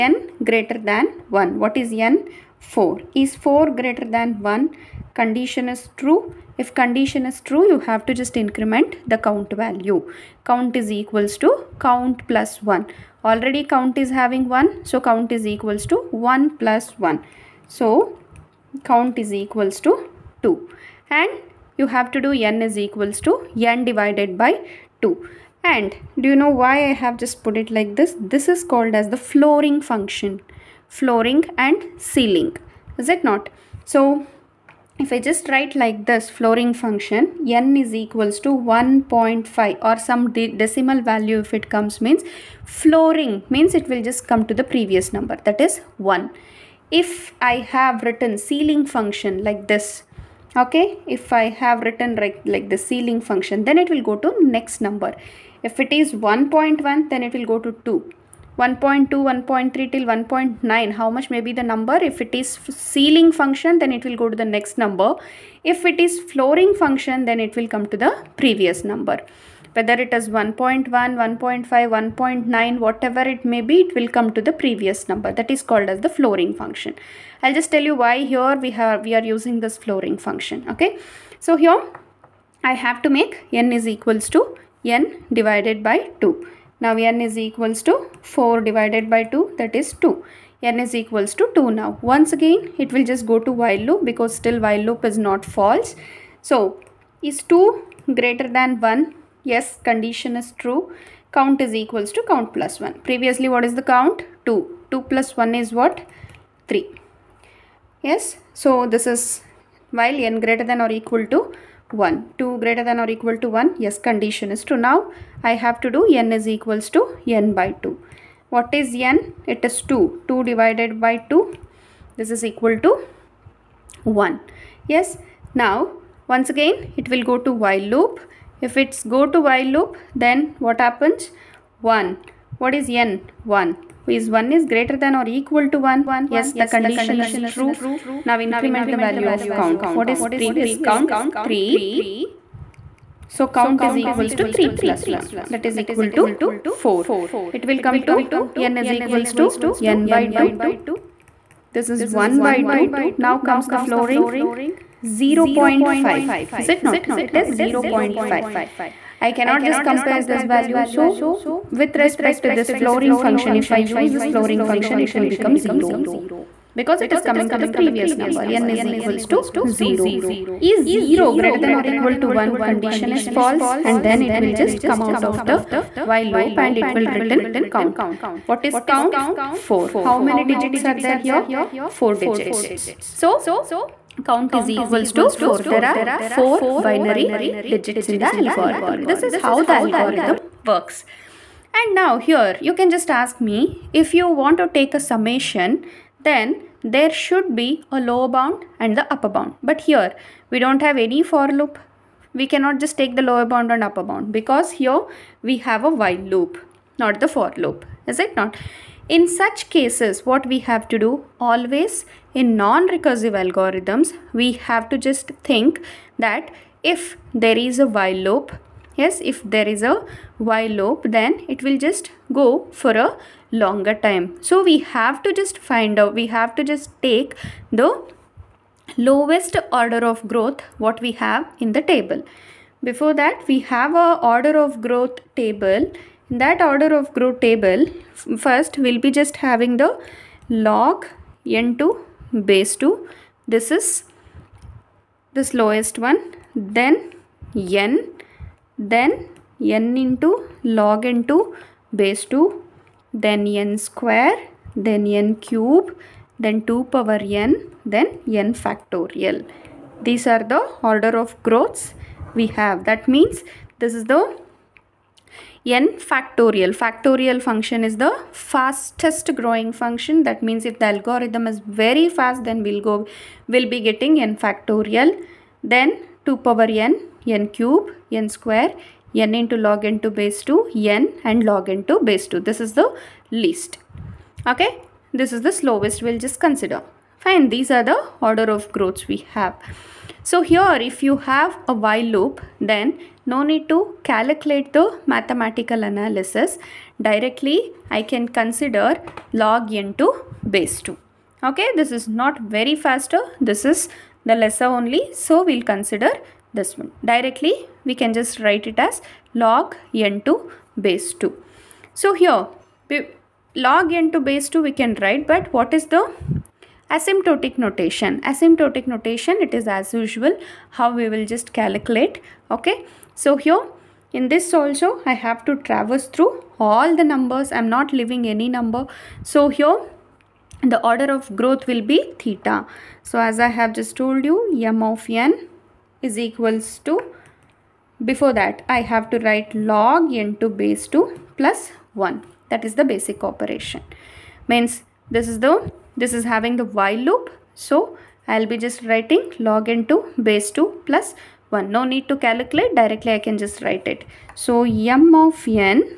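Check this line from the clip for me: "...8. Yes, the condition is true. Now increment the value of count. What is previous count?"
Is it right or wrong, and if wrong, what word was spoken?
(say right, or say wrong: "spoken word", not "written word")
wrong: "1", not "8".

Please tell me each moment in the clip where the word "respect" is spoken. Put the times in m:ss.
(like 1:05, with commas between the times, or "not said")
2:41.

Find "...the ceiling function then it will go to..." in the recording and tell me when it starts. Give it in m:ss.
0:52.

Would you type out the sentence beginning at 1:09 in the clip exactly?
Whether it is 1.1, 1.5, 1.9, whatever it may be, it will come to the previous number.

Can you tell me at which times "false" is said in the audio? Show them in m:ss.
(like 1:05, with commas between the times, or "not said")
1:35, 2:53.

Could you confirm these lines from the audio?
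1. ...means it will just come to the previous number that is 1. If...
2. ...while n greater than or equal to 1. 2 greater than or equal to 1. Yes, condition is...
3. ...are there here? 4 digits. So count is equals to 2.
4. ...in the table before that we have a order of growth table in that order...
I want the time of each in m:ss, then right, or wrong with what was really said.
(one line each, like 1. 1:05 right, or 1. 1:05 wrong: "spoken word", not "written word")
1. 0:43 right
2. 1:49 right
3. 3:00 wrong: "4", not "2"
4. 3:51 right.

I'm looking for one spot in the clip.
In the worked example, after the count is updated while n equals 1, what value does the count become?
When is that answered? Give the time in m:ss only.
2:24.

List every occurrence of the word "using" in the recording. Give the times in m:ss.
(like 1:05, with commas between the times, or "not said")
1:19.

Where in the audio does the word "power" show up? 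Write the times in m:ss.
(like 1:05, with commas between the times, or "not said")
4:16, 4:36.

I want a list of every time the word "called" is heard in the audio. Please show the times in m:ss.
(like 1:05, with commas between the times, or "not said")
0:28, 1:15.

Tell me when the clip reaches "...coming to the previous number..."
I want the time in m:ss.
2:47.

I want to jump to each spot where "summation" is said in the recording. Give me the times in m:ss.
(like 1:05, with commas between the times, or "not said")
3:14.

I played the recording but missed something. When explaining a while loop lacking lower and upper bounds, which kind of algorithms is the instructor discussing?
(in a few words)
non-recursive algorithms.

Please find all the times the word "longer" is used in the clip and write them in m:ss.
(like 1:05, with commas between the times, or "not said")
3:43.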